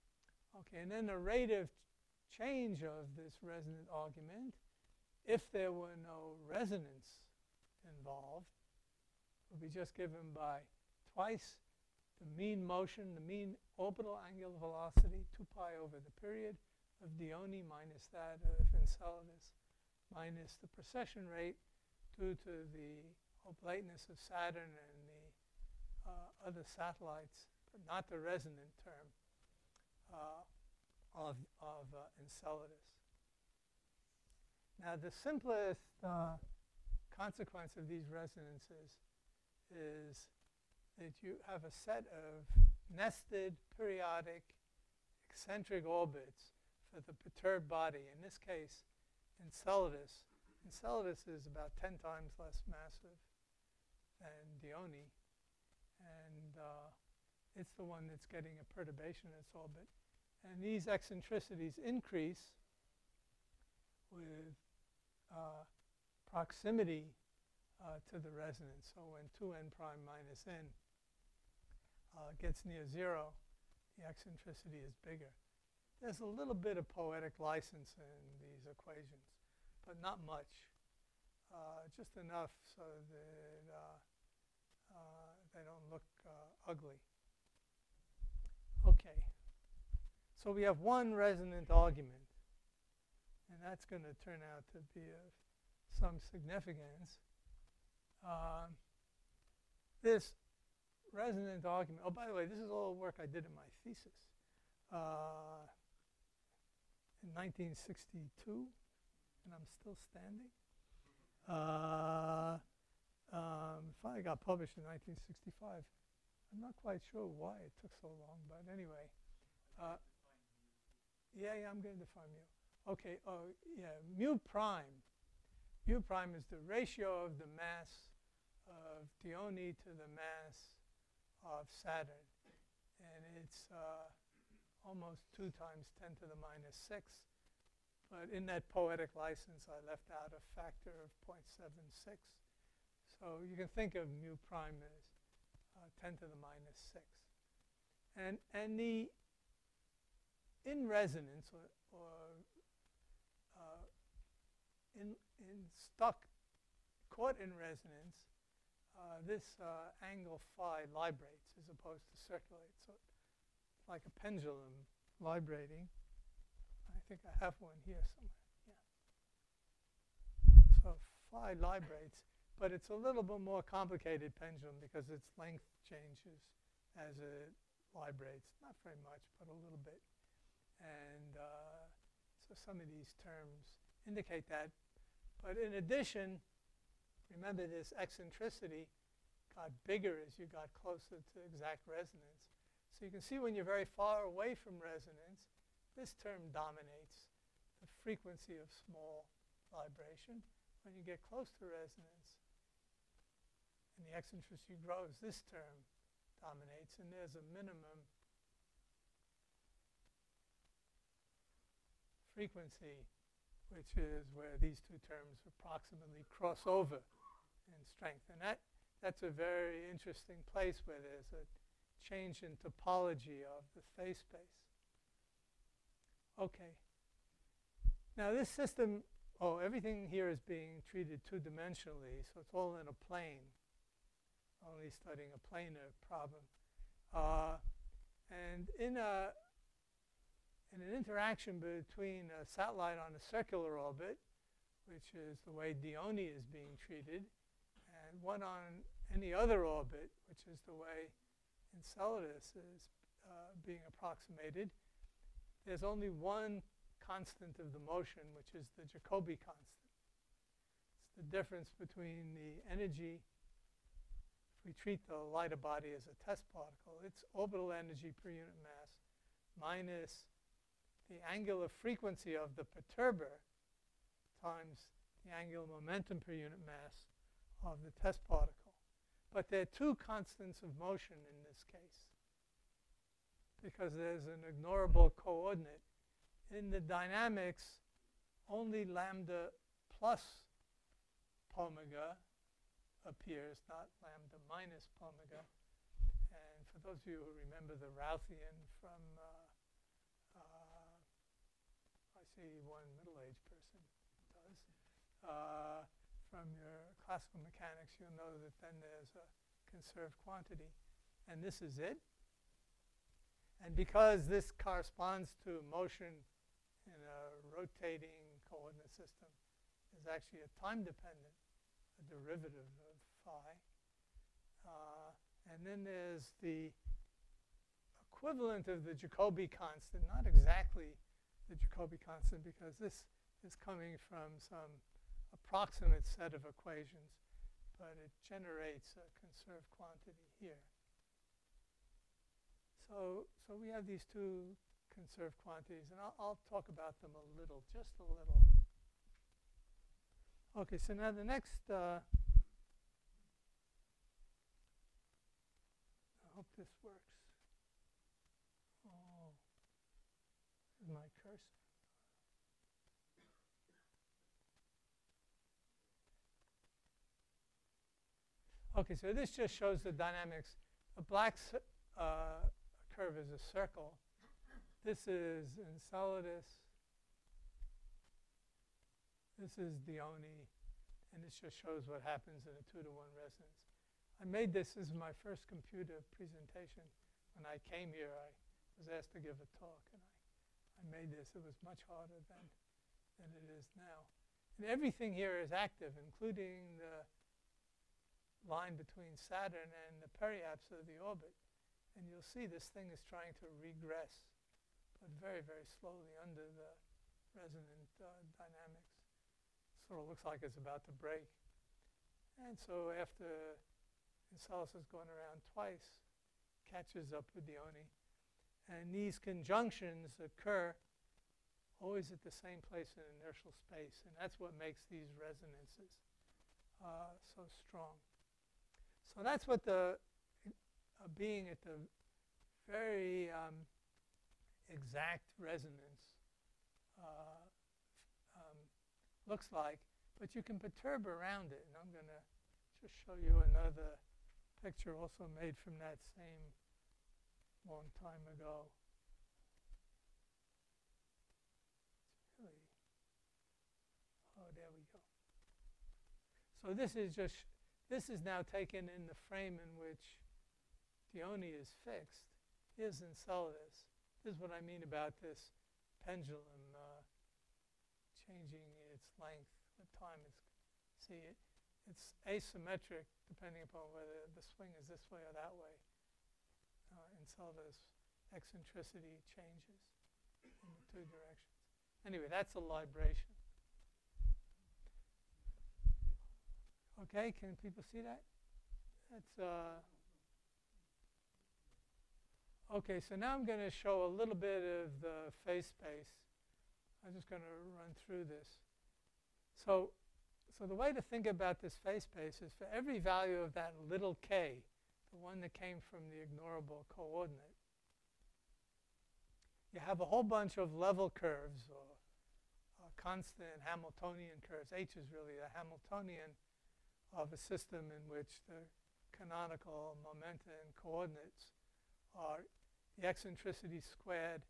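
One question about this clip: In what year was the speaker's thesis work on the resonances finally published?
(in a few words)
1965.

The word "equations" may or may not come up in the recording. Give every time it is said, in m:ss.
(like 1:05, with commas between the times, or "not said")
1:18, 5:36.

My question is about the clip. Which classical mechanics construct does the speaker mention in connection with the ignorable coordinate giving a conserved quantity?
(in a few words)
the Routhian.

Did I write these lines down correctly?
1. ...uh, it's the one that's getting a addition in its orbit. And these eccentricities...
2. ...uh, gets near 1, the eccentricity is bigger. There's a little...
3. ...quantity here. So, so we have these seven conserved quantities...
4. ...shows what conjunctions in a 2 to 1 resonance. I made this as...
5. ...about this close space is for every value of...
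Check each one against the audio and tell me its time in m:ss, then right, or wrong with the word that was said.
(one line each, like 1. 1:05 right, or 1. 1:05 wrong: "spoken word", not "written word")
1. 0:56 wrong: "perturbation", not "addition"
2. 1:12 wrong: "0", not "1"
3. 5:39 wrong: "two", not "seven"
4. 6:21 wrong: "happens", not "conjunctions"
5. 8:21 wrong: "phase", not "close".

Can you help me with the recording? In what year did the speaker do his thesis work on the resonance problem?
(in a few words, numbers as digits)
1962.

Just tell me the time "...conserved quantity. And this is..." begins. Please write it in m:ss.
5:09.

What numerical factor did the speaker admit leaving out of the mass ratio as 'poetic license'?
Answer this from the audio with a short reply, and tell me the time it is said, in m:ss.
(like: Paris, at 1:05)
0.76, at 2:21.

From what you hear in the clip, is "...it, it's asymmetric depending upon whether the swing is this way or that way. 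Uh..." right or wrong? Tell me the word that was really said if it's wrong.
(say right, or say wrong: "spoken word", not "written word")
right.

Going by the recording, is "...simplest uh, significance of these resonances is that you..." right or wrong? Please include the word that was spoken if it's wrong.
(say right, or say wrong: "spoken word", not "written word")
wrong: "consequence", not "significance".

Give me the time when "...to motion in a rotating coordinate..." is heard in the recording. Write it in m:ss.
5:15.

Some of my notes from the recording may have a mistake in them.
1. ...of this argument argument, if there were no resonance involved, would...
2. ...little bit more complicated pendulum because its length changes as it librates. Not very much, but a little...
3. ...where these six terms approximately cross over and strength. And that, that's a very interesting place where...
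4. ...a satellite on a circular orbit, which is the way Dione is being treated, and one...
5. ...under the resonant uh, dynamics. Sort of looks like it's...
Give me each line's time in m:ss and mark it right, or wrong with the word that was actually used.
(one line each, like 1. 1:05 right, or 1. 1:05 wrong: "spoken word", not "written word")
1. 0:02 wrong: "resonant", not "argument"
2. 2:52 right
3. 3:34 wrong: "two", not "six"
4. 4:02 right
5. 6:46 right.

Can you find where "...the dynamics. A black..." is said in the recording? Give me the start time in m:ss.
6:09.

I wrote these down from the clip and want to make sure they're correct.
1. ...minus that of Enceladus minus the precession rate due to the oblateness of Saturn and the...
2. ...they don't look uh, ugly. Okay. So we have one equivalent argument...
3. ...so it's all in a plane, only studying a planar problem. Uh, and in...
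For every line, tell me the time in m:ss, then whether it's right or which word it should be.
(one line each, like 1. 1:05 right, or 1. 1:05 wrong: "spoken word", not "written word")
1. 0:17 right
2. 1:25 wrong: "resonant", not "equivalent"
3. 3:52 right.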